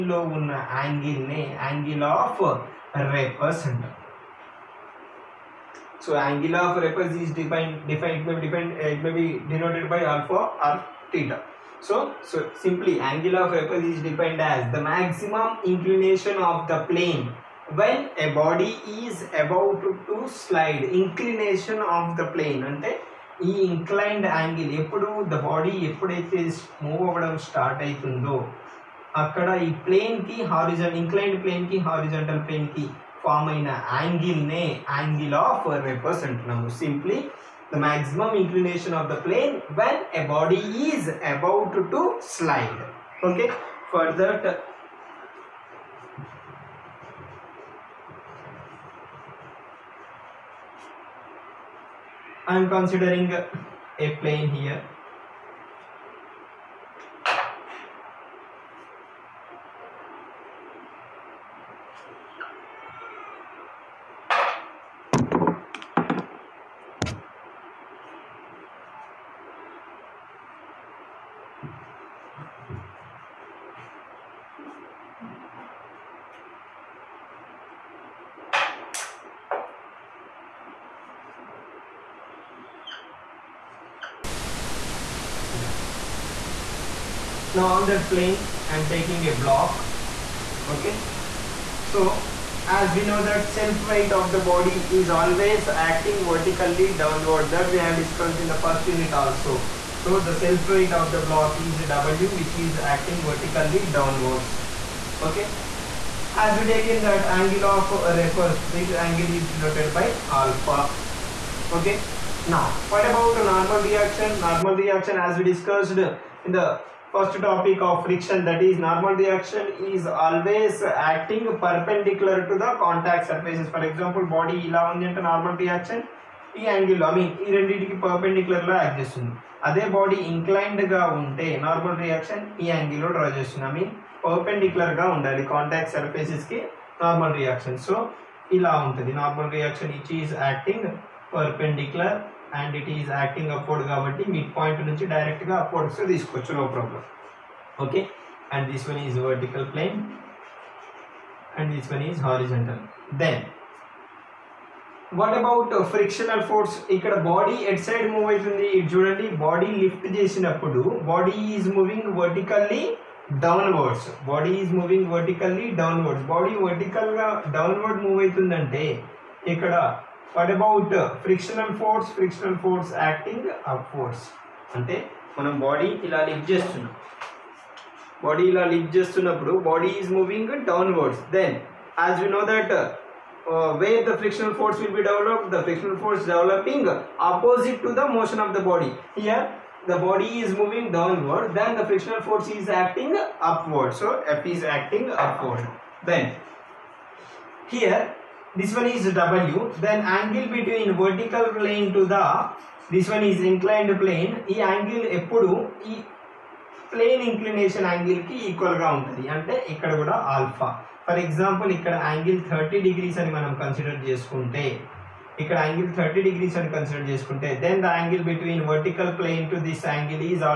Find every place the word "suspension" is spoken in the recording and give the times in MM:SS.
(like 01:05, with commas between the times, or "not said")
not said.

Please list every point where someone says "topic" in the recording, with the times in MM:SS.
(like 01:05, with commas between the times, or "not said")
01:57.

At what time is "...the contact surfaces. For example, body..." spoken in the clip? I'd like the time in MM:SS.
02:02.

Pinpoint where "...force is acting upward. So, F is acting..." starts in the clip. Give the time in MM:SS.
03:12.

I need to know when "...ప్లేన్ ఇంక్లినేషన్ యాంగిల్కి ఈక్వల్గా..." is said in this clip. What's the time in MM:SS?
03:26.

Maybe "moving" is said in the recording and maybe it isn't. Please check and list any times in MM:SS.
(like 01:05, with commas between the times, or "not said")
03:00, 03:10.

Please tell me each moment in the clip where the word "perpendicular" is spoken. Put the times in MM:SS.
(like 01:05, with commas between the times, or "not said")
02:01.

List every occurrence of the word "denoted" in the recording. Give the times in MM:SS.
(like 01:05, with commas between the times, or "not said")
01:49.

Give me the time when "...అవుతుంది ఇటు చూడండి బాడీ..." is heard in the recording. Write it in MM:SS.
02:38.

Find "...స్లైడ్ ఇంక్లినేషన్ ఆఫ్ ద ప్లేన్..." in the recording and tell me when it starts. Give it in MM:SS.
00:20.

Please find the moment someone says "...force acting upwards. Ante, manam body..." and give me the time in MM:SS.
02:52.